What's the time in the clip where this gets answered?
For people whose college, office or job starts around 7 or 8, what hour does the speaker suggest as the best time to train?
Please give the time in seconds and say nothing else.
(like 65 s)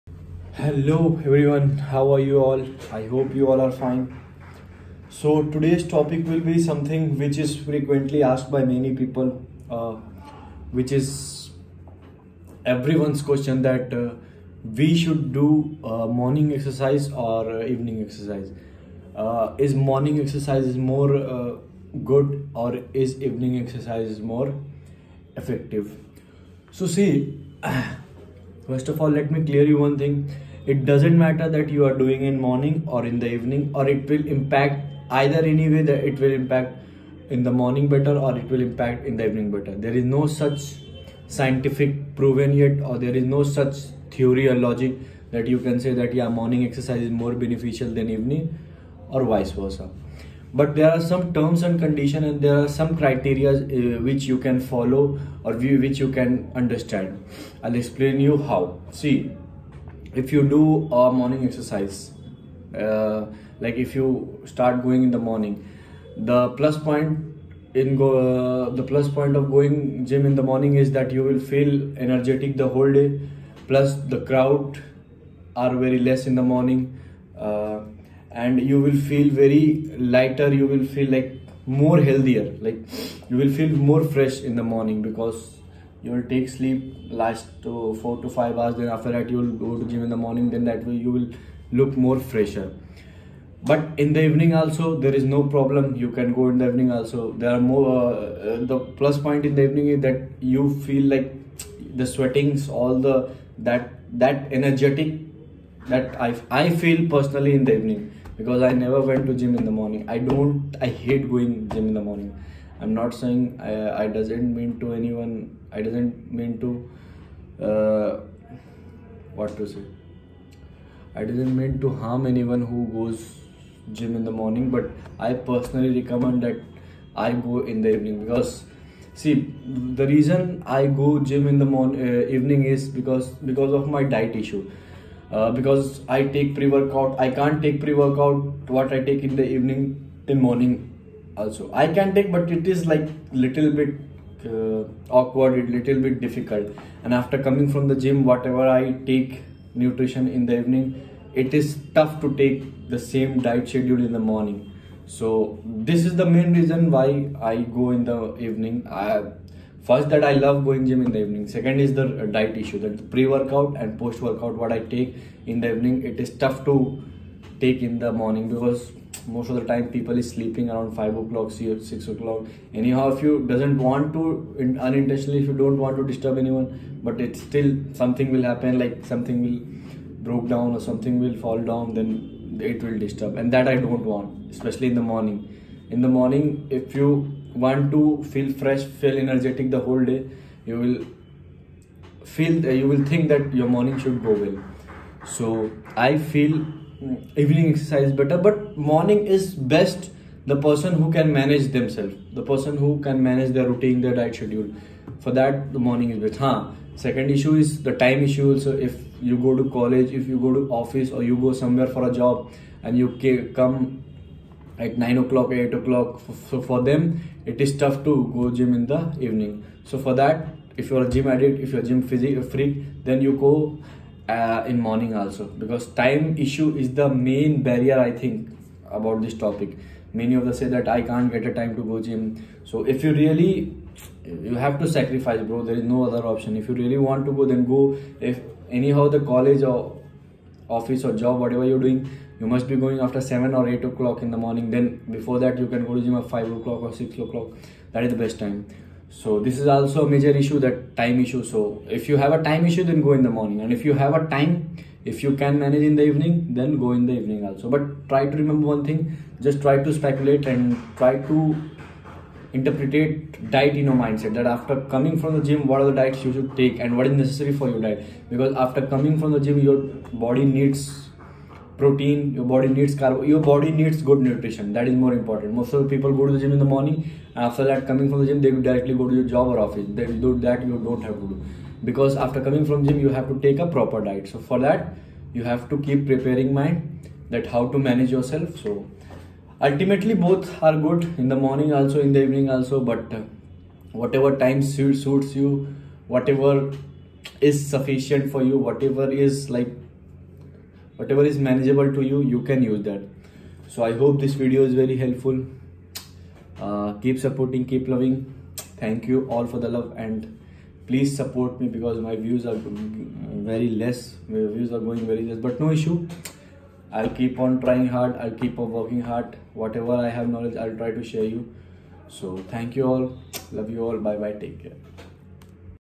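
246 s.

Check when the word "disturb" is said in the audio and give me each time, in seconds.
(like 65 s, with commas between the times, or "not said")
176 s, 183 s.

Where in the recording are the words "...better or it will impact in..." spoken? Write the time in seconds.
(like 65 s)
37 s.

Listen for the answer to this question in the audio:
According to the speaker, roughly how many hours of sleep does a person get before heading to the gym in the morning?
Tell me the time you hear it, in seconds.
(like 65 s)
88 s.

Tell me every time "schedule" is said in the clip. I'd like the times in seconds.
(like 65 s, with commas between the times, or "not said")
153 s, 204 s.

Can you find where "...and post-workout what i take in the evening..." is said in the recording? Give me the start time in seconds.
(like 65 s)
163 s.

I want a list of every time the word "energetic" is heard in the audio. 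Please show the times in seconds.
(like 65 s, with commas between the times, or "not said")
72 s, 104 s, 189 s.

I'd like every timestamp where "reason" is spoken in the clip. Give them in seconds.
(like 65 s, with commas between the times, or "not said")
130 s, 156 s.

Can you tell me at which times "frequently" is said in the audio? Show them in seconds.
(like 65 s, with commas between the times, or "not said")
7 s.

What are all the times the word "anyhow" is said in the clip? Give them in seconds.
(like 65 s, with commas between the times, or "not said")
172 s, 238 s.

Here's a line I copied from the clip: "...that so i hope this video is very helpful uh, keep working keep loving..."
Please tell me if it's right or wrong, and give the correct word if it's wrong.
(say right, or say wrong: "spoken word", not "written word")
wrong: "supporting", not "working".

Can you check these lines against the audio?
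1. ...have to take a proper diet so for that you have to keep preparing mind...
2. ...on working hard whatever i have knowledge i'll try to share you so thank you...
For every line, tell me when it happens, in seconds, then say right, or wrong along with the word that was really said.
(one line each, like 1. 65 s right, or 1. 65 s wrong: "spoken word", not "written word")
1. 283 s right
2. 318 s right.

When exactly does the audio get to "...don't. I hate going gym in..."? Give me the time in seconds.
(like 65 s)
110 s.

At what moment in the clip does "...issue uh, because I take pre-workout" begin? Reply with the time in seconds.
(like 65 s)
134 s.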